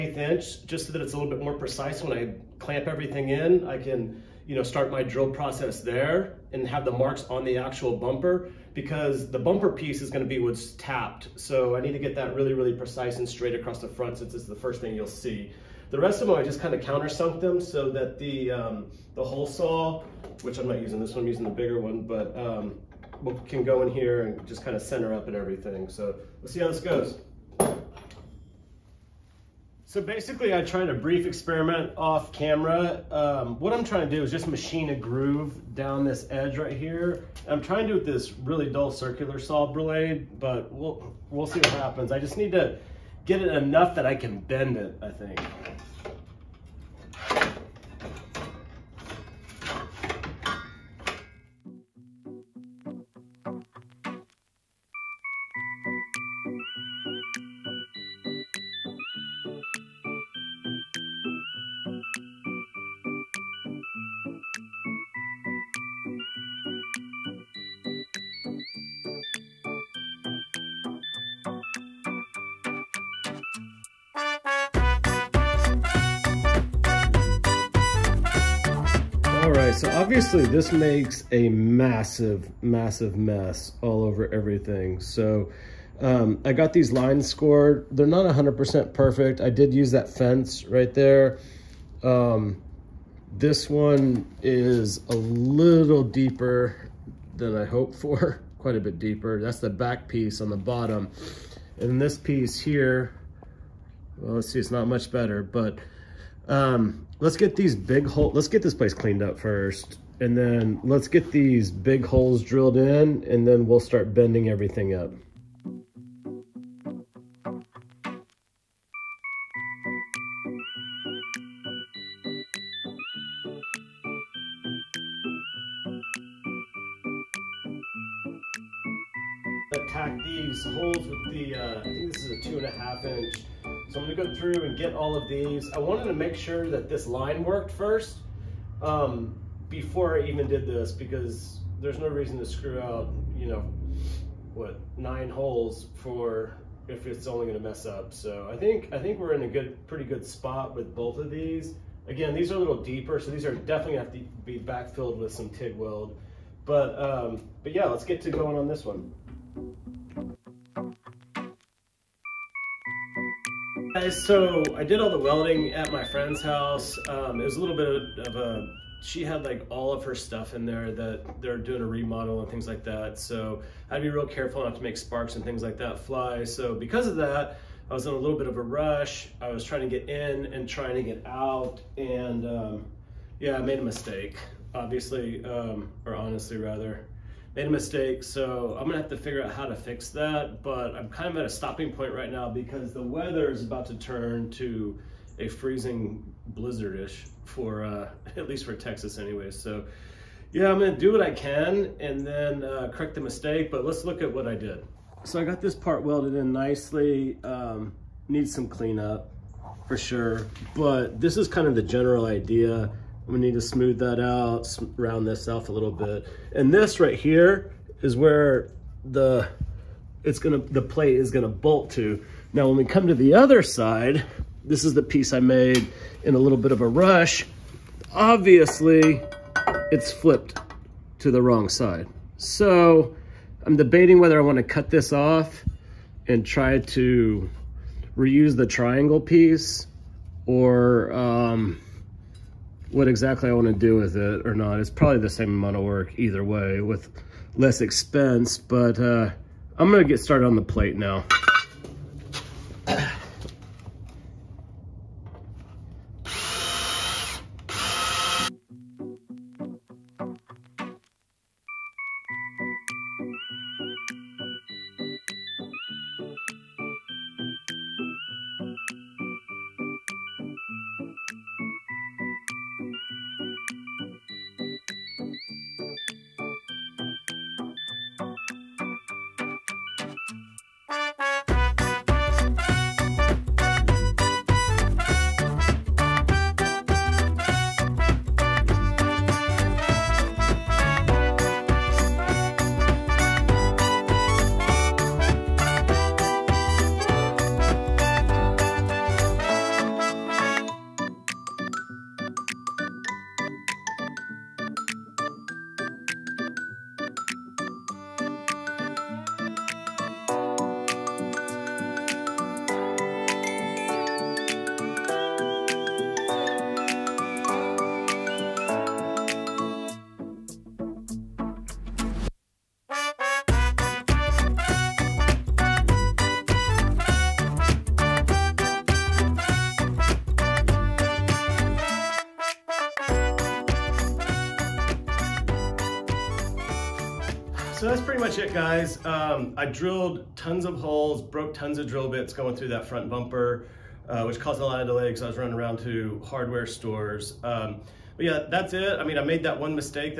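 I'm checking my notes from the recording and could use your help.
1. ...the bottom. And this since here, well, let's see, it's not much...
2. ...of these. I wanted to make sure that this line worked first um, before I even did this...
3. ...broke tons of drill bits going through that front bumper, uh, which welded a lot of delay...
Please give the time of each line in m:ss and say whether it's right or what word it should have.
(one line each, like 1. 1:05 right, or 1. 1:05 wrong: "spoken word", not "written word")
1. 1:40 wrong: "piece", not "since"
2. 2:15 right
3. 5:41 wrong: "caused", not "welded".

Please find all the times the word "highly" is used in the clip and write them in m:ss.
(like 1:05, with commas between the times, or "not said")
not said.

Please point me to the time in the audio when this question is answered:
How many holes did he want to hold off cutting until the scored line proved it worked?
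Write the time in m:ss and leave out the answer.
2:24.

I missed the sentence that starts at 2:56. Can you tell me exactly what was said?
So because of that, I was in a little bit of a rush.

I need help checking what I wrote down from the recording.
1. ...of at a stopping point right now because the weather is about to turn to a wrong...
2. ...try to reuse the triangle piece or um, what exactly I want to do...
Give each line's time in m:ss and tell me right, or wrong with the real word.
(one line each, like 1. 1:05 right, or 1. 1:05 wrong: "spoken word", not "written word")
1. 3:11 wrong: "freezing", not "wrong"
2. 3:56 right.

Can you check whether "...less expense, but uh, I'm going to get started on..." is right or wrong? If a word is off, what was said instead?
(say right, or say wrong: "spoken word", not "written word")
right.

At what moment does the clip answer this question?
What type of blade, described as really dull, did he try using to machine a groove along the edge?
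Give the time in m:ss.
0:38.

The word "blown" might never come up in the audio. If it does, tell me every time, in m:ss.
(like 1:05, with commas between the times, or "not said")
not said.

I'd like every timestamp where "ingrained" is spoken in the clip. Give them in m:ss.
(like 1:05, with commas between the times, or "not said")
not said.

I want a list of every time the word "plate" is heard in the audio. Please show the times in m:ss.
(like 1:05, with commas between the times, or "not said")
3:40, 4:10.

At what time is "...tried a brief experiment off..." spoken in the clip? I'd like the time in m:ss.
0:30.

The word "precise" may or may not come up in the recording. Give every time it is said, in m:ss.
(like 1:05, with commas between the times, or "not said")
0:01, 0:12.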